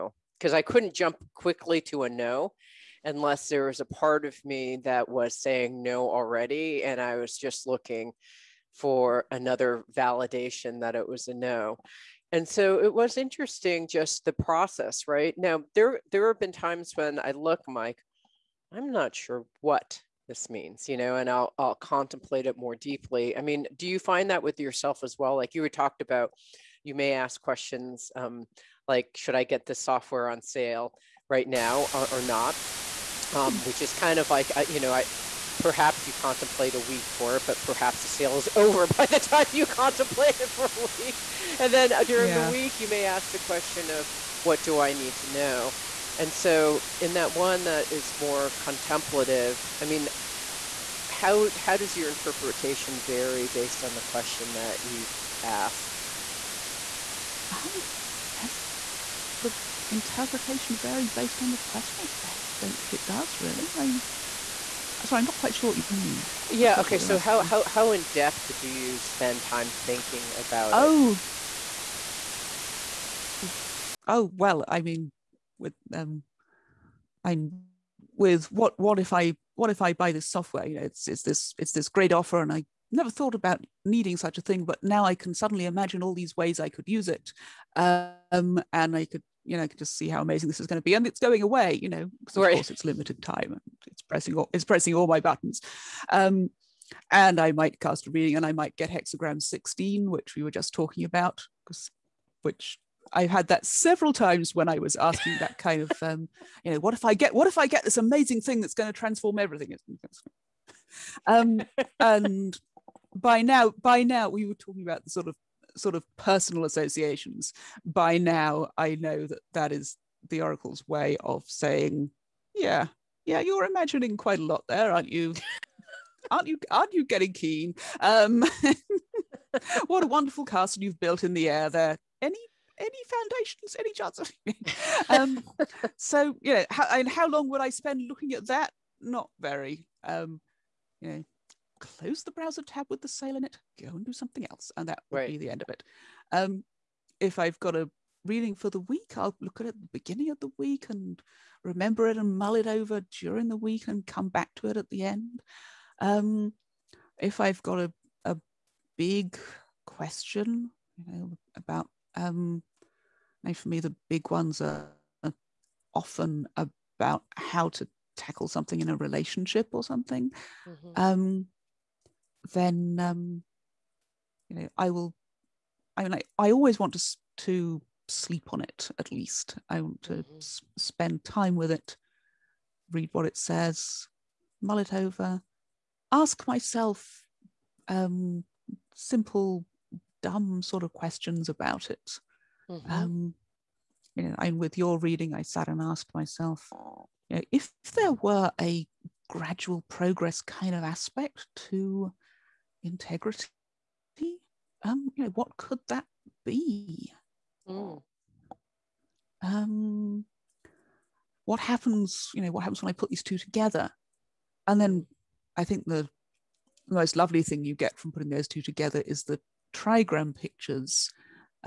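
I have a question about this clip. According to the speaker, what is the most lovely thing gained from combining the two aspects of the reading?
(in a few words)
the trigram pictures.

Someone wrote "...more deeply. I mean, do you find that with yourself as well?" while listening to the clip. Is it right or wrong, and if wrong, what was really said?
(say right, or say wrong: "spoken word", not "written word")
right.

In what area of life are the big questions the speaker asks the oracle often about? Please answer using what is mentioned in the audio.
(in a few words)
a relationship.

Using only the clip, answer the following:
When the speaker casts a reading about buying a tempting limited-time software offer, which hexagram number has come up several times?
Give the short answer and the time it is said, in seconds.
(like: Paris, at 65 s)
16, at 98 s.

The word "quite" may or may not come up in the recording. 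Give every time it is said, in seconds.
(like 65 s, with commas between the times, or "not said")
65 s, 124 s.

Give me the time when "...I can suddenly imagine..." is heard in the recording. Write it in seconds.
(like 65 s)
85 s.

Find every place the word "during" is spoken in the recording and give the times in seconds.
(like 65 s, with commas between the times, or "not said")
42 s, 153 s.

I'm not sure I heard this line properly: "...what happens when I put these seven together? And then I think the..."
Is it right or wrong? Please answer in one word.
wrong.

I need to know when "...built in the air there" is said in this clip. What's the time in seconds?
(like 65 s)
130 s.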